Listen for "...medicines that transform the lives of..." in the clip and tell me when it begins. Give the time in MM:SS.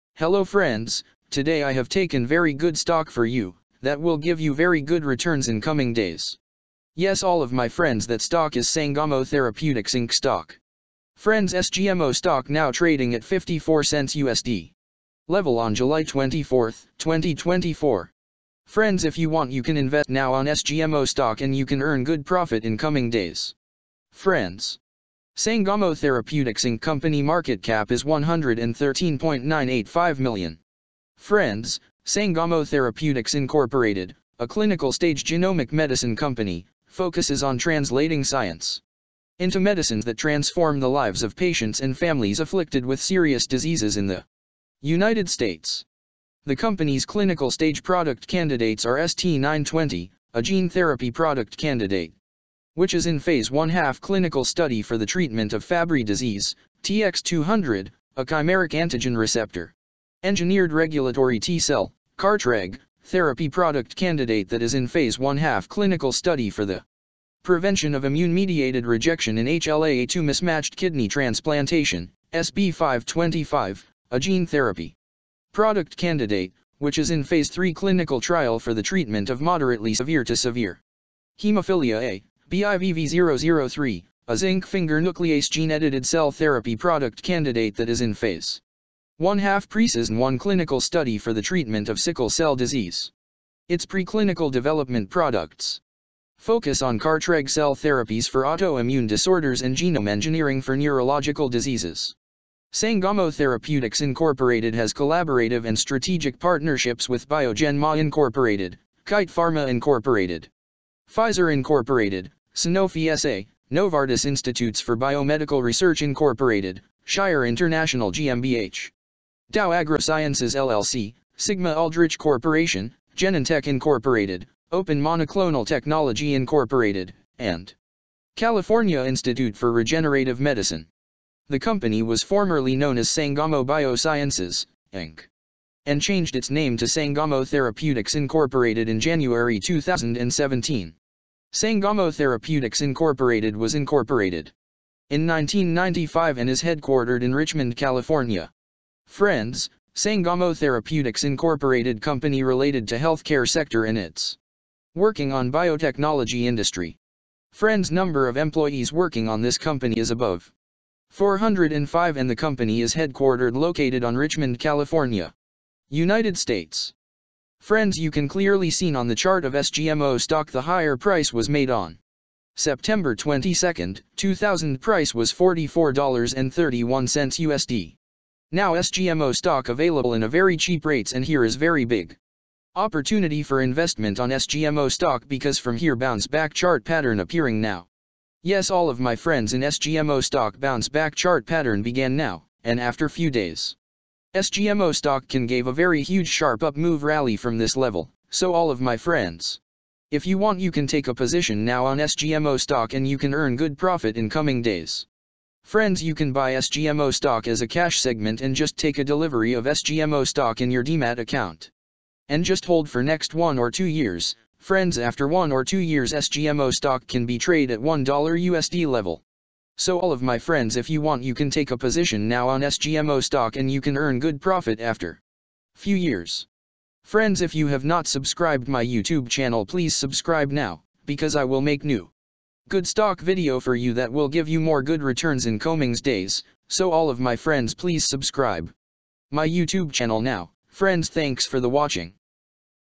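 00:39.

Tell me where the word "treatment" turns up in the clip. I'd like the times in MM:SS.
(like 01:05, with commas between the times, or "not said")
00:55, 01:18, 01:31.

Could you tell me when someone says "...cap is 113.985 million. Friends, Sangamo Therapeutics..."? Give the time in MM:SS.
00:27.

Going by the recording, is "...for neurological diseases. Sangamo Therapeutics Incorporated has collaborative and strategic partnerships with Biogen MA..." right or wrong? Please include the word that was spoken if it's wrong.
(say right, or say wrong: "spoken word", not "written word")
right.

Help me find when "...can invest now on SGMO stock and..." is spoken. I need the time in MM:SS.
00:19.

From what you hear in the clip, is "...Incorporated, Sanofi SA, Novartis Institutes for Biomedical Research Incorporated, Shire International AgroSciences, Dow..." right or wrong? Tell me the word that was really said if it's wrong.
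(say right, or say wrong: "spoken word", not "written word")
wrong: "GmbH", not "AgroSciences".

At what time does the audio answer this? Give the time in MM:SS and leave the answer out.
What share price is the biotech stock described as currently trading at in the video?
00:13.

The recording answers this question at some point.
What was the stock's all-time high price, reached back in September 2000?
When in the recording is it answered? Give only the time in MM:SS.
02:55.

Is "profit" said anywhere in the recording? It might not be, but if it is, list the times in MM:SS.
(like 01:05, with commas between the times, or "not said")
00:22, 03:23, 03:44.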